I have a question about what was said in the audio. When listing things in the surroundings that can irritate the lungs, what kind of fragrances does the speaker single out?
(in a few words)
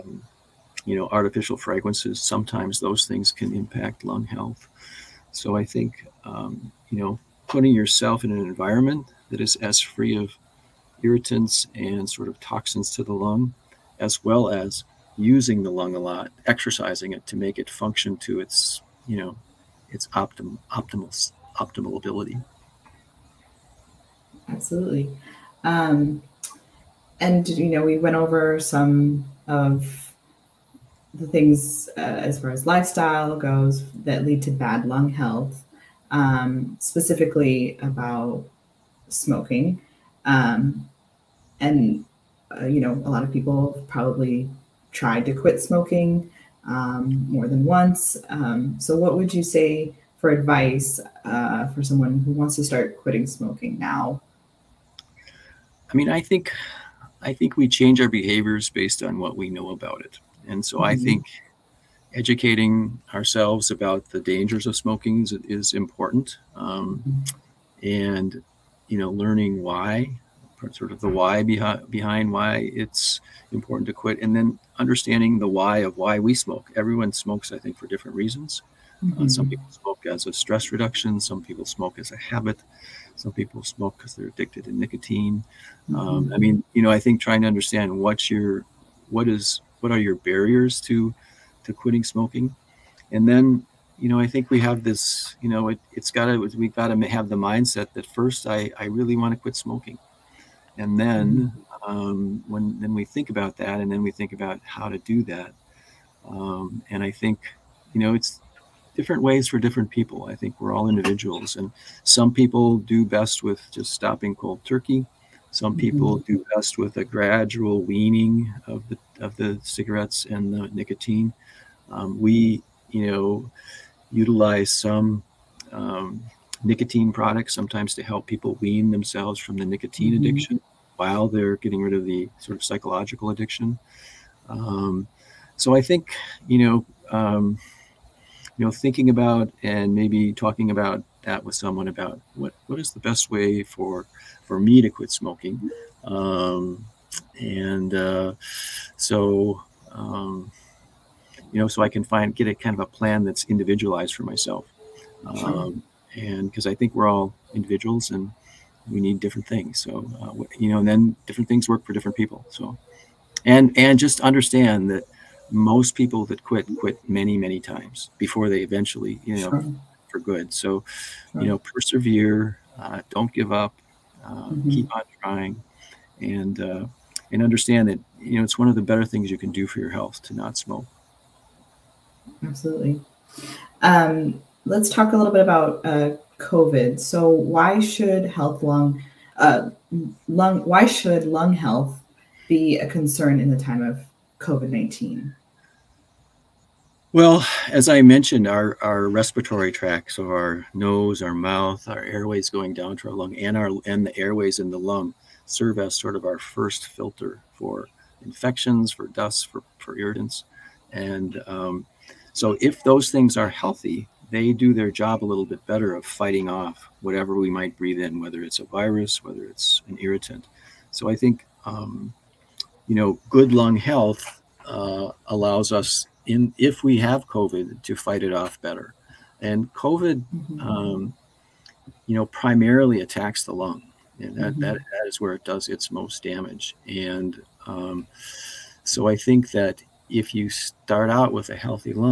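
artificial fragrances.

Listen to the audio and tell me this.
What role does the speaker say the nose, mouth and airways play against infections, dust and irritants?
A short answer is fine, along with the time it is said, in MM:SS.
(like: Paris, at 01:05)
first filter, at 03:26.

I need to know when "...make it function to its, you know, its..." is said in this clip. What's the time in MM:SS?
00:17.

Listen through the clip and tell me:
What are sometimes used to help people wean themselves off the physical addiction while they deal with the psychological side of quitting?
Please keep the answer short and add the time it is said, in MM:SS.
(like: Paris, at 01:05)
nicotine products, at 02:06.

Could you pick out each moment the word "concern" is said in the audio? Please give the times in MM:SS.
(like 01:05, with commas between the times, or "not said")
03:12.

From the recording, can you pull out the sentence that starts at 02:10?
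addiction while they're getting rid of the sort of psychological addiction.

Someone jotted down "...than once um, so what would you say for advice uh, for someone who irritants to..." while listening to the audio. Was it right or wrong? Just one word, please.
wrong.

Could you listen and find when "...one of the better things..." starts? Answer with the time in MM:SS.
02:58.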